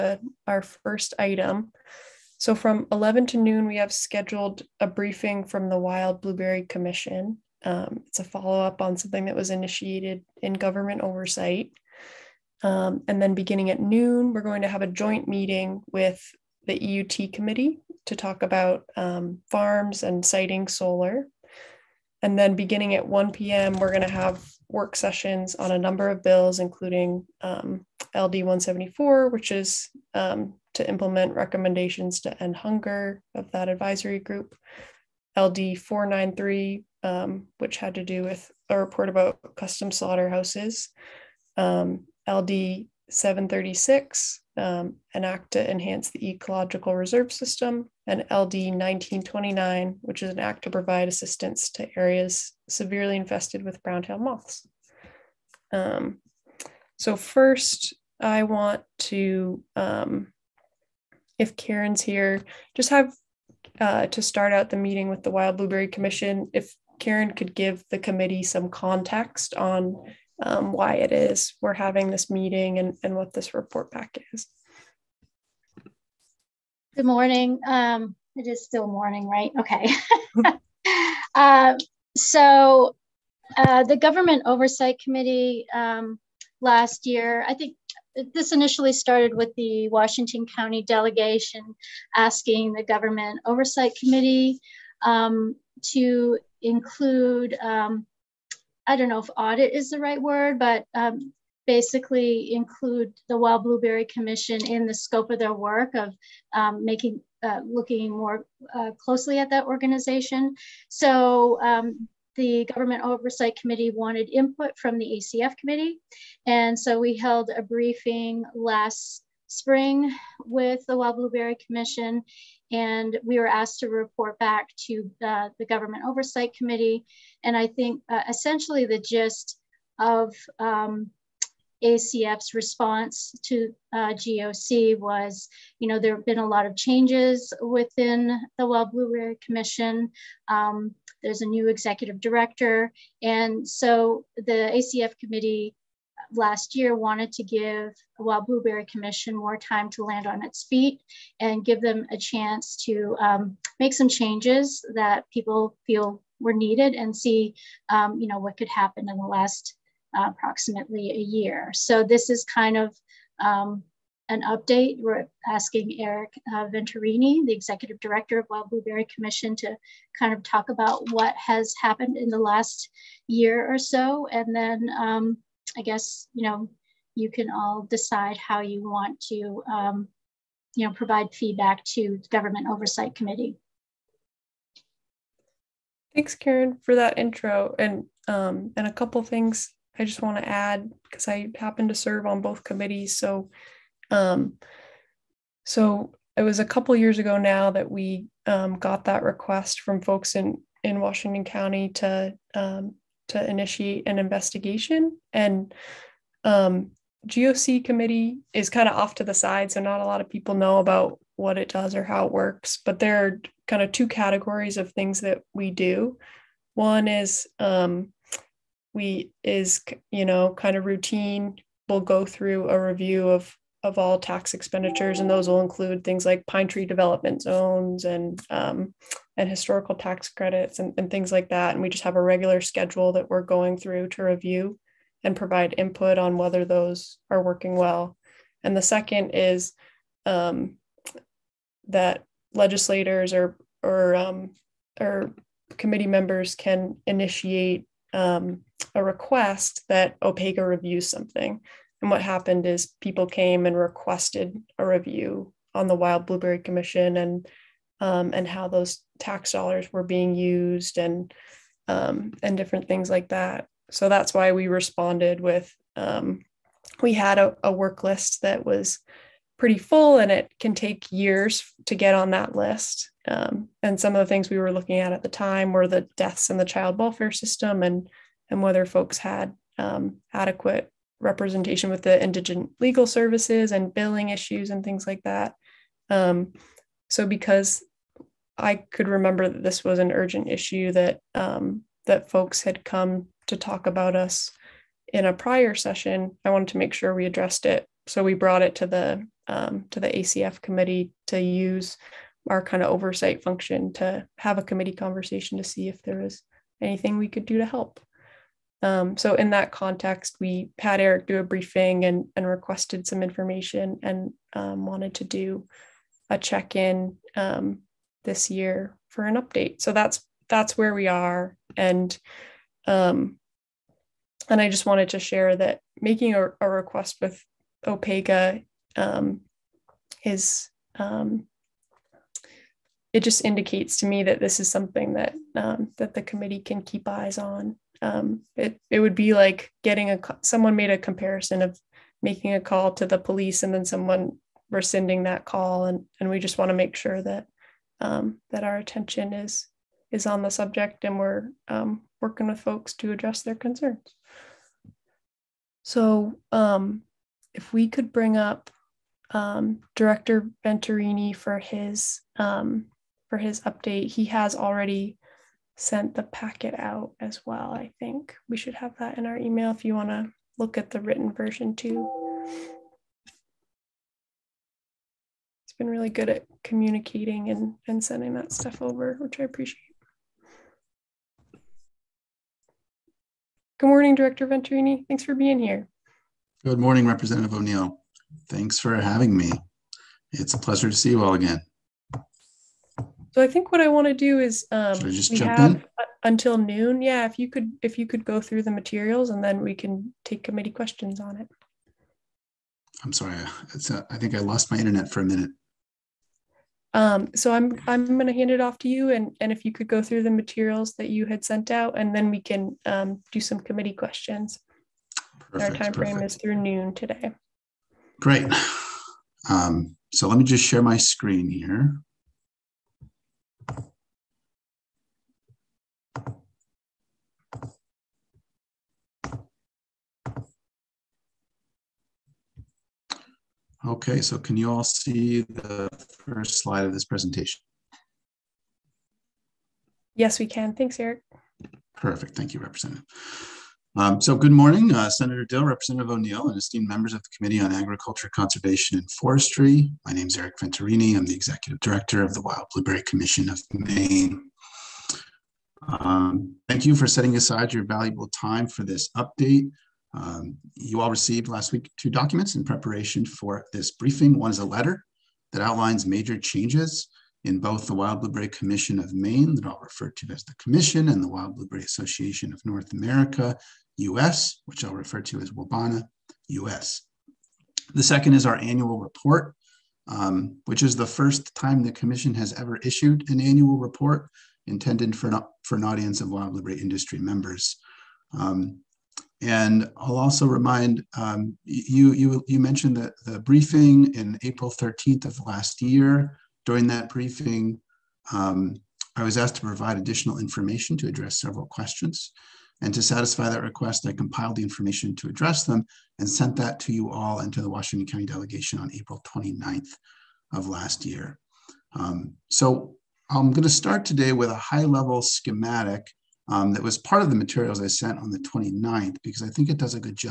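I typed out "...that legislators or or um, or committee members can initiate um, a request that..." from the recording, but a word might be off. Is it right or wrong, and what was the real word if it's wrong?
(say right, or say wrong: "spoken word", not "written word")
right.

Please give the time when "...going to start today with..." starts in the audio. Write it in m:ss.
8:33.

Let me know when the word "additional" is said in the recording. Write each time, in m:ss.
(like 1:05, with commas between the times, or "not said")
8:19.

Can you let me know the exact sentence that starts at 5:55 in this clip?
So um, if we could bring up um, Director Venturini for his um, for his update.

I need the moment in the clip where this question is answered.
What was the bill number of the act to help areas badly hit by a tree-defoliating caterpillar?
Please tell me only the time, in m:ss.
0:48.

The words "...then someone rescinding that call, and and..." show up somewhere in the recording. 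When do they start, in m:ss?
5:43.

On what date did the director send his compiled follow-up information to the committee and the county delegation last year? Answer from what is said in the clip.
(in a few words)
April 29th.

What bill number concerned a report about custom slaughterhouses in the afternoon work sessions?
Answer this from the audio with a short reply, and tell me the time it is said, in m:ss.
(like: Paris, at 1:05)
LD 493, at 0:35.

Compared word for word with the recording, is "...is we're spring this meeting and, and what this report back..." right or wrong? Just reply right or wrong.
wrong.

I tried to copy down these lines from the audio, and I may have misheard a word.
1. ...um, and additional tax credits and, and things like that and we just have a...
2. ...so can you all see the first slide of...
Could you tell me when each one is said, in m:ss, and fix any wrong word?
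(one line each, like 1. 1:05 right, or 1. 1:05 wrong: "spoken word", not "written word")
1. 3:48 wrong: "historical", not "additional"
2. 7:14 right.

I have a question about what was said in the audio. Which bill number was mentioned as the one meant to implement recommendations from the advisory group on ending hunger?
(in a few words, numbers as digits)
LD 174.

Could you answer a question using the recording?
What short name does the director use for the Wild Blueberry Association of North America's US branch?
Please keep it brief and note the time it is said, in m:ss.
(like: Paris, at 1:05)
WABANA, at 7:55.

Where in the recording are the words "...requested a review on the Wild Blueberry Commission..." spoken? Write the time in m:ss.
4:13.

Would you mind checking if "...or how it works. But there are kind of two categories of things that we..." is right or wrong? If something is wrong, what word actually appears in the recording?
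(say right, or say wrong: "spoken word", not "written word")
right.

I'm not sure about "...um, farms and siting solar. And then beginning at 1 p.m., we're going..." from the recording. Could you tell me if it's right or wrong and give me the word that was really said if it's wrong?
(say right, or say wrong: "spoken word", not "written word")
right.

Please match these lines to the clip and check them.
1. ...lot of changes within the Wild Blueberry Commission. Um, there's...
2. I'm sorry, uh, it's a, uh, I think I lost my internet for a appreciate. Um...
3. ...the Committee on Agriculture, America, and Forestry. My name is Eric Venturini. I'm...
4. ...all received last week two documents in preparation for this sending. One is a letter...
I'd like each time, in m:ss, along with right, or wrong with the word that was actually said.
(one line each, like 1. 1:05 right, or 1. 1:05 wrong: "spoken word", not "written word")
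1. 2:16 right
2. 6:43 wrong: "minute", not "appreciate"
3. 7:27 wrong: "Conservation", not "America"
4. 7:40 wrong: "briefing", not "sending".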